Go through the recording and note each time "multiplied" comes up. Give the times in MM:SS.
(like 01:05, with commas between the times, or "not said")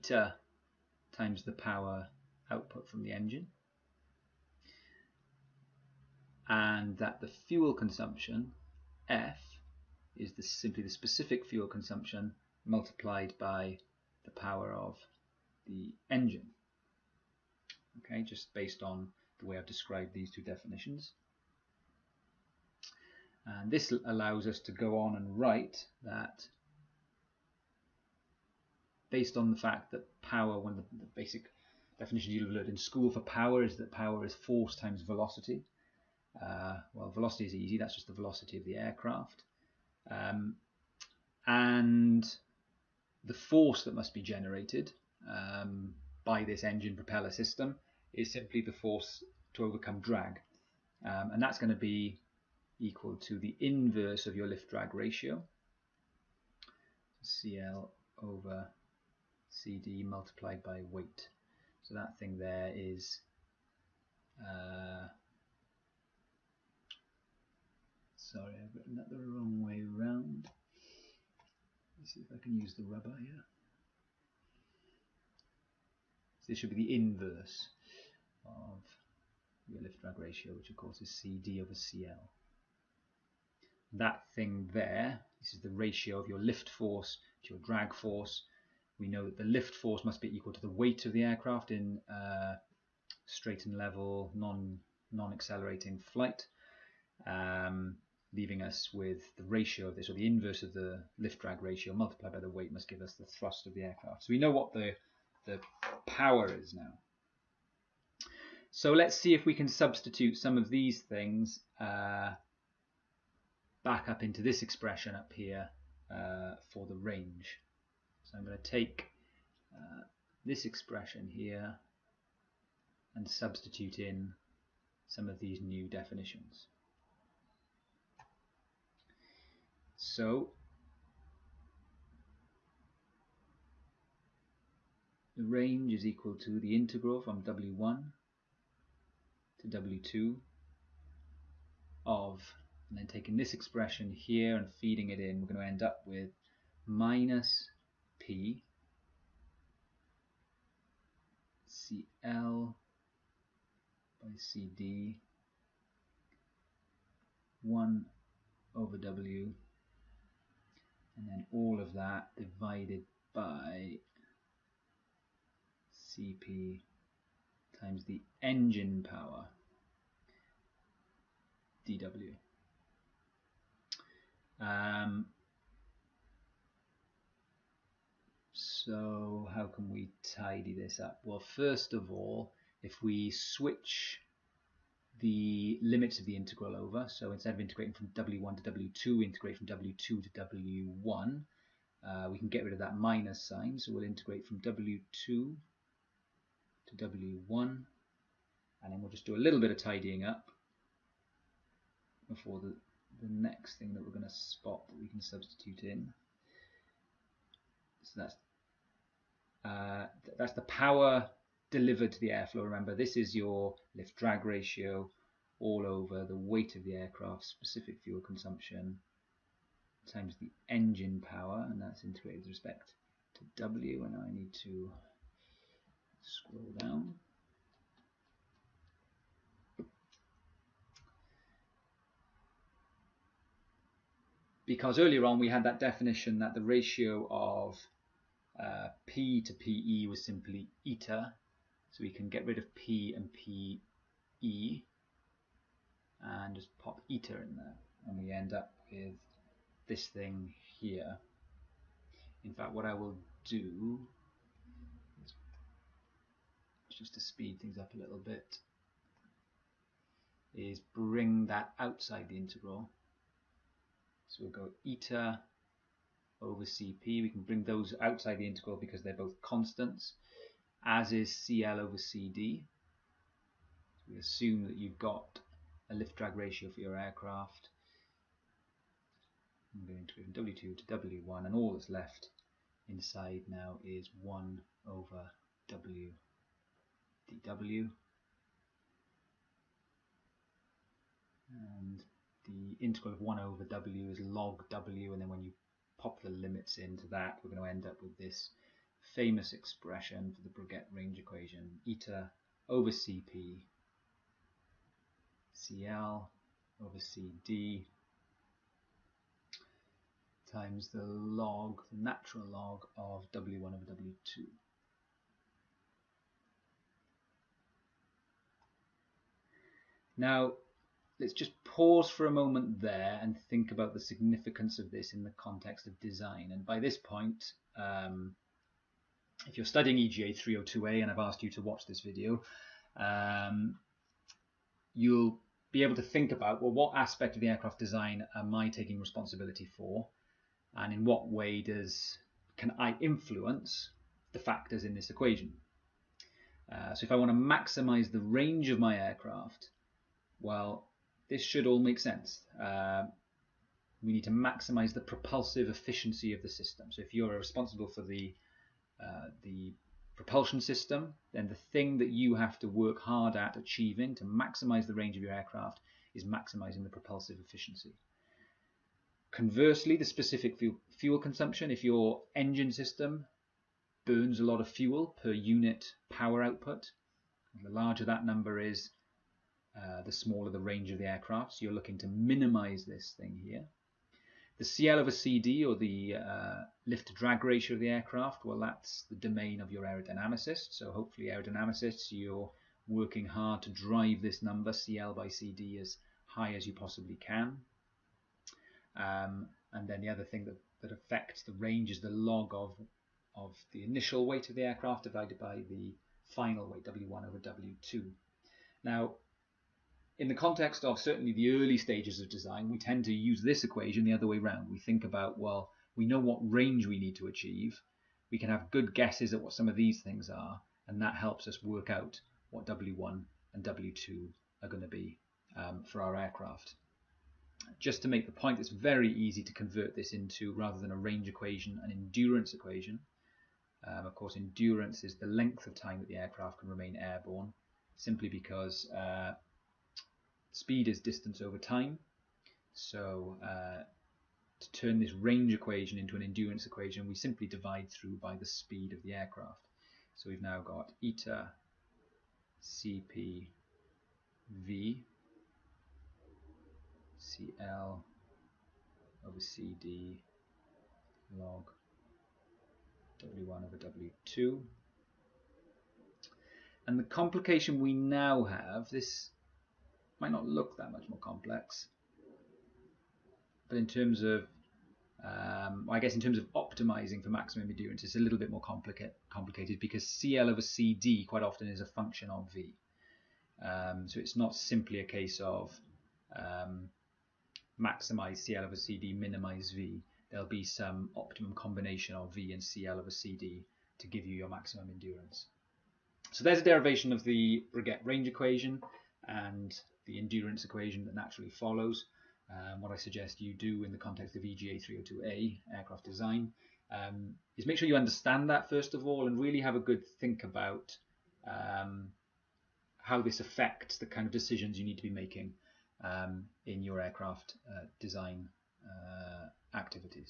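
00:12, 01:00, 01:41.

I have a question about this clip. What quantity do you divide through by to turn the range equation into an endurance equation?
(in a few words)
Speed of the aircraft.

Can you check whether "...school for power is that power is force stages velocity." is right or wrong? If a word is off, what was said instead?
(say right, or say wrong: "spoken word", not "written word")
wrong: "times", not "stages".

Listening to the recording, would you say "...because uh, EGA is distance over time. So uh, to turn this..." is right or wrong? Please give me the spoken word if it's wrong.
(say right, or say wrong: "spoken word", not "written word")
wrong: "Speed", not "EGA".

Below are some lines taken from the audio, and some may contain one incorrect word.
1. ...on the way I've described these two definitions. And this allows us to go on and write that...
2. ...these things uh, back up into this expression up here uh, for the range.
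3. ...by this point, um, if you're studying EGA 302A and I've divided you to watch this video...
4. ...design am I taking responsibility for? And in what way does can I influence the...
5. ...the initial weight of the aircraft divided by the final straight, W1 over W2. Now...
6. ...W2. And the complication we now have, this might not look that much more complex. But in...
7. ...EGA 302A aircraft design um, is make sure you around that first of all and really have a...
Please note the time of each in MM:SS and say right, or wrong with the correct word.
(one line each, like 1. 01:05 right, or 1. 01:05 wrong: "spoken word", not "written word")
1. 00:18 right
2. 01:50 right
3. 05:26 wrong: "asked", not "divided"
4. 05:37 right
5. 06:43 wrong: "weight", not "straight"
6. 07:43 right
7. 08:24 wrong: "understand", not "around".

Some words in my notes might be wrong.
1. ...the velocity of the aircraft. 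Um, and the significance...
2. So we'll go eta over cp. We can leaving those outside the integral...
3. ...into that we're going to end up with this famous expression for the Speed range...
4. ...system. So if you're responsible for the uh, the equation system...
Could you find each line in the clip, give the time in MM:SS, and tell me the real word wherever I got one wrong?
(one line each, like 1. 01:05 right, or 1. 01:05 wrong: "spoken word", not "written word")
1. 00:38 wrong: "force", not "significance"
2. 04:24 wrong: "bring", not "leaving"
3. 04:56 wrong: "Breguet", not "Speed"
4. 05:56 wrong: "propulsion", not "equation".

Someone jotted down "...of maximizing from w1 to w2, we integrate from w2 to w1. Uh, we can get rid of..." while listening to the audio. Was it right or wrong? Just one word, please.
wrong.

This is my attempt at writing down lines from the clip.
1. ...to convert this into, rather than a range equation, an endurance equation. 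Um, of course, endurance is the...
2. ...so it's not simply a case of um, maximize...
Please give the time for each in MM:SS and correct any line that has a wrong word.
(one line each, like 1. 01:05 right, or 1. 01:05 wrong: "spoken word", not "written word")
1. 07:09 right
2. 08:04 right.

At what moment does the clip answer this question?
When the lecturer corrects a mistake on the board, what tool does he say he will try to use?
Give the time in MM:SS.
01:12.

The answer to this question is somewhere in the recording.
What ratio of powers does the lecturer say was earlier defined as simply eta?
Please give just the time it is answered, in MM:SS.
03:59.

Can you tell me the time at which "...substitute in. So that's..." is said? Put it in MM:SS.
03:25.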